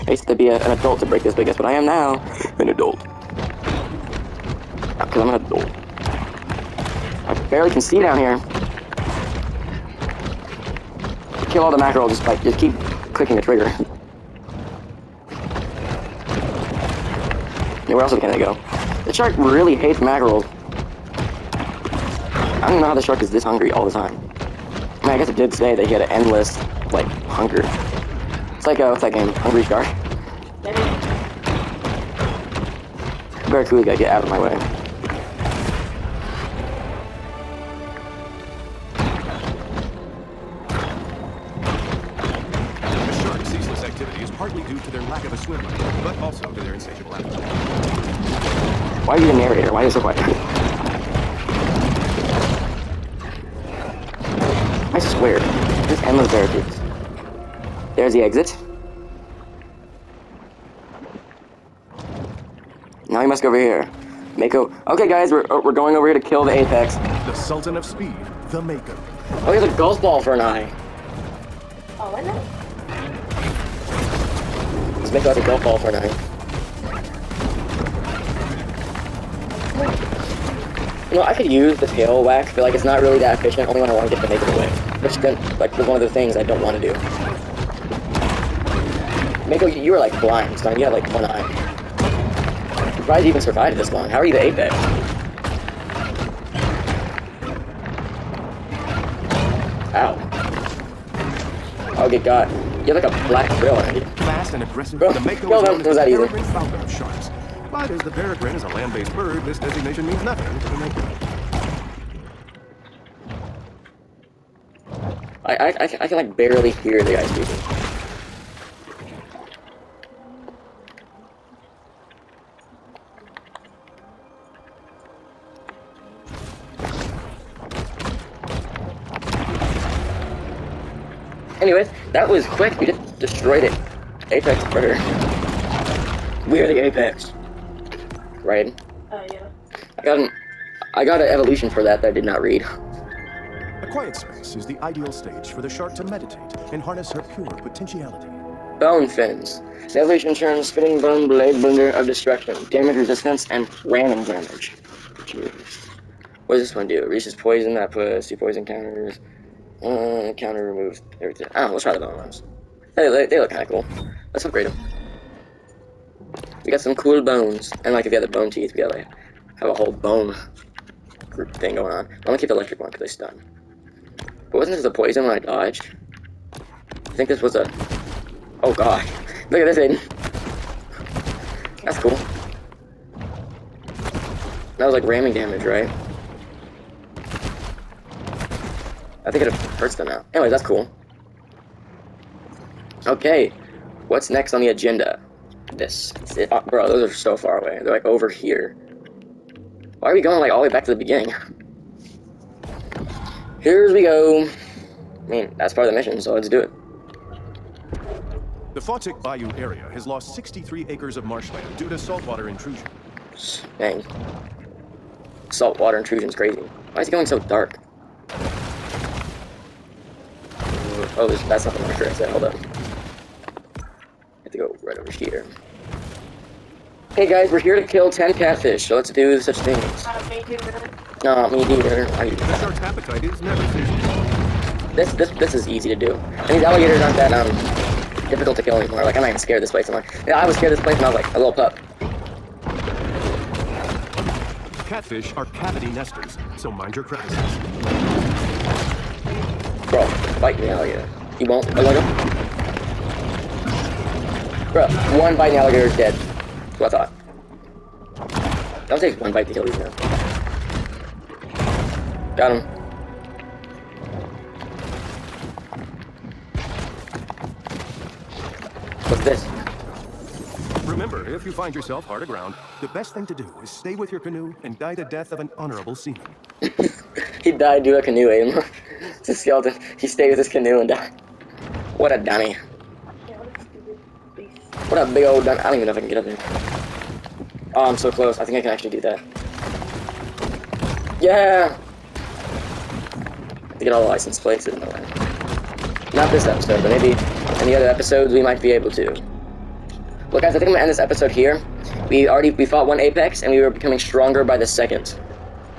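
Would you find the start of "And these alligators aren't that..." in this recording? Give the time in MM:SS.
03:56.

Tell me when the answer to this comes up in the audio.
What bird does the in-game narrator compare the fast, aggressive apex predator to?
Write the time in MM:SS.
01:45.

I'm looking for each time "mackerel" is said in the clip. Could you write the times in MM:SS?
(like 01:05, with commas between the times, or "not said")
00:11, 00:19.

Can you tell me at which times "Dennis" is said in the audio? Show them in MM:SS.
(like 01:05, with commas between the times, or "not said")
not said.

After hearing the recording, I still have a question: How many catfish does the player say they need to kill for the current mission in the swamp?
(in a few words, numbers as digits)
10.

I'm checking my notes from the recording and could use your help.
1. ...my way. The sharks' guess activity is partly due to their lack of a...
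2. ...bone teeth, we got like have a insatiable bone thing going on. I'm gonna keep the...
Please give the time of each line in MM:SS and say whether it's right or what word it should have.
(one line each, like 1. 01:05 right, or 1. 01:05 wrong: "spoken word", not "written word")
1. 00:34 wrong: "ceaseless", not "guess"
2. 02:48 wrong: "whole", not "insatiable".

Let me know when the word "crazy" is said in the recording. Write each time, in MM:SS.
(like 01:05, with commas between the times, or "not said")
03:36.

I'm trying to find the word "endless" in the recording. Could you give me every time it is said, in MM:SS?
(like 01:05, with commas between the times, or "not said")
00:26, 00:56.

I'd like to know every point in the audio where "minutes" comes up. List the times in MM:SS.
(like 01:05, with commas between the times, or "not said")
not said.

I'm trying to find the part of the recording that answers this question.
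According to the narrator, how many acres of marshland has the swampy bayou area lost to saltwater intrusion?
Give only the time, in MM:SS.
03:30.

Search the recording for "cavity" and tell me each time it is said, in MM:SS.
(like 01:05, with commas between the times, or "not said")
04:05.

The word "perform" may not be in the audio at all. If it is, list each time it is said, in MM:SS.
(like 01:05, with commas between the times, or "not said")
not said.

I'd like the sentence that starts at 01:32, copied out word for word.
I'm surprised you even survived this long.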